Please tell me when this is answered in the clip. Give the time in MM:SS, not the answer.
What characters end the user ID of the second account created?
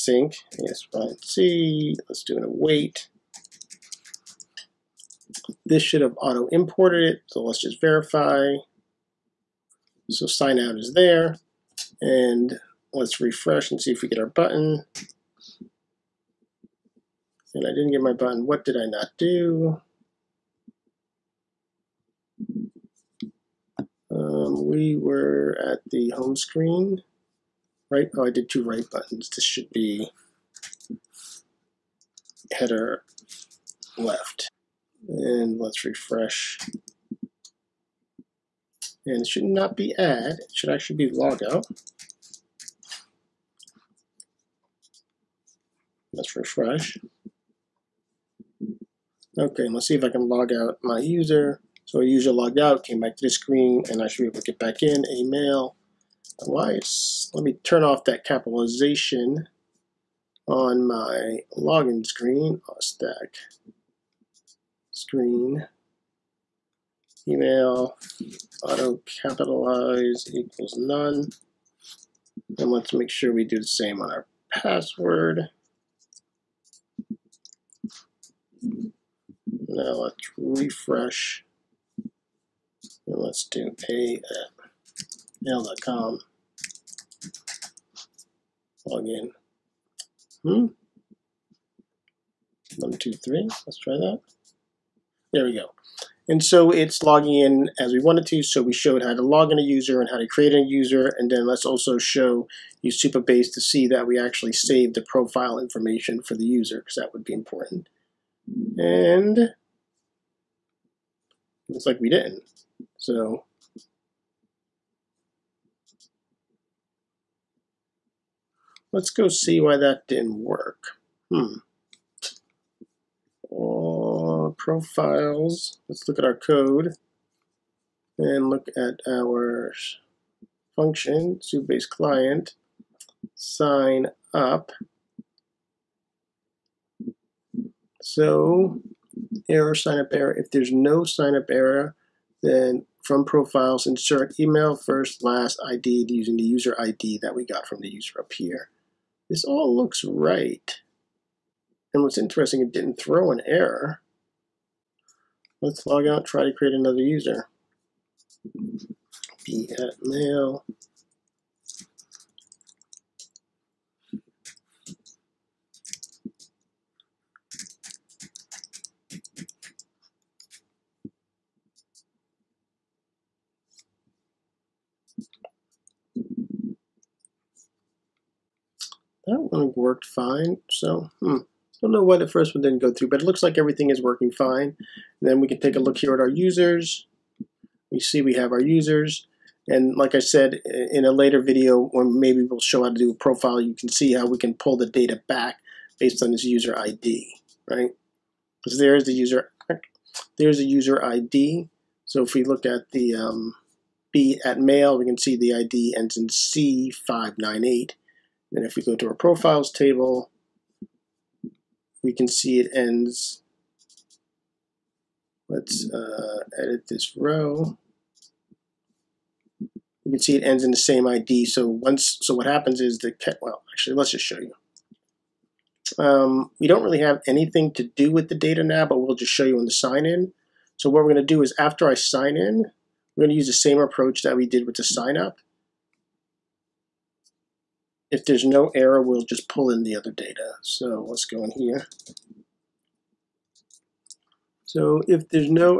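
03:26.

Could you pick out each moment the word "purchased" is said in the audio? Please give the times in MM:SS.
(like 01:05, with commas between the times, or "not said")
not said.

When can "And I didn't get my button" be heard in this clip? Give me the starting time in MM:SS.
00:17.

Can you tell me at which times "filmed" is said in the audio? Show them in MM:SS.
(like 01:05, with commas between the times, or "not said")
not said.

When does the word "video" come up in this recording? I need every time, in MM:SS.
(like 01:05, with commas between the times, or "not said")
03:11.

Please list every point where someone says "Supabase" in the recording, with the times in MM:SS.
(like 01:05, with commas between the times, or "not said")
02:11.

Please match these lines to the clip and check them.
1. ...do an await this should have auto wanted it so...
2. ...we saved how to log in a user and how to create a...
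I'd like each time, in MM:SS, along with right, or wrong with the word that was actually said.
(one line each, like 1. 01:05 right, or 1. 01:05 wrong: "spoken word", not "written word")
1. 00:02 wrong: "imported", not "wanted"
2. 01:38 wrong: "showed", not "saved".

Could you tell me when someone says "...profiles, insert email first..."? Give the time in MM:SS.
02:23.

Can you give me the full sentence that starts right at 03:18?
Because there's the user, there's the user ID.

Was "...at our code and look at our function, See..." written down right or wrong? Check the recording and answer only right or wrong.
wrong.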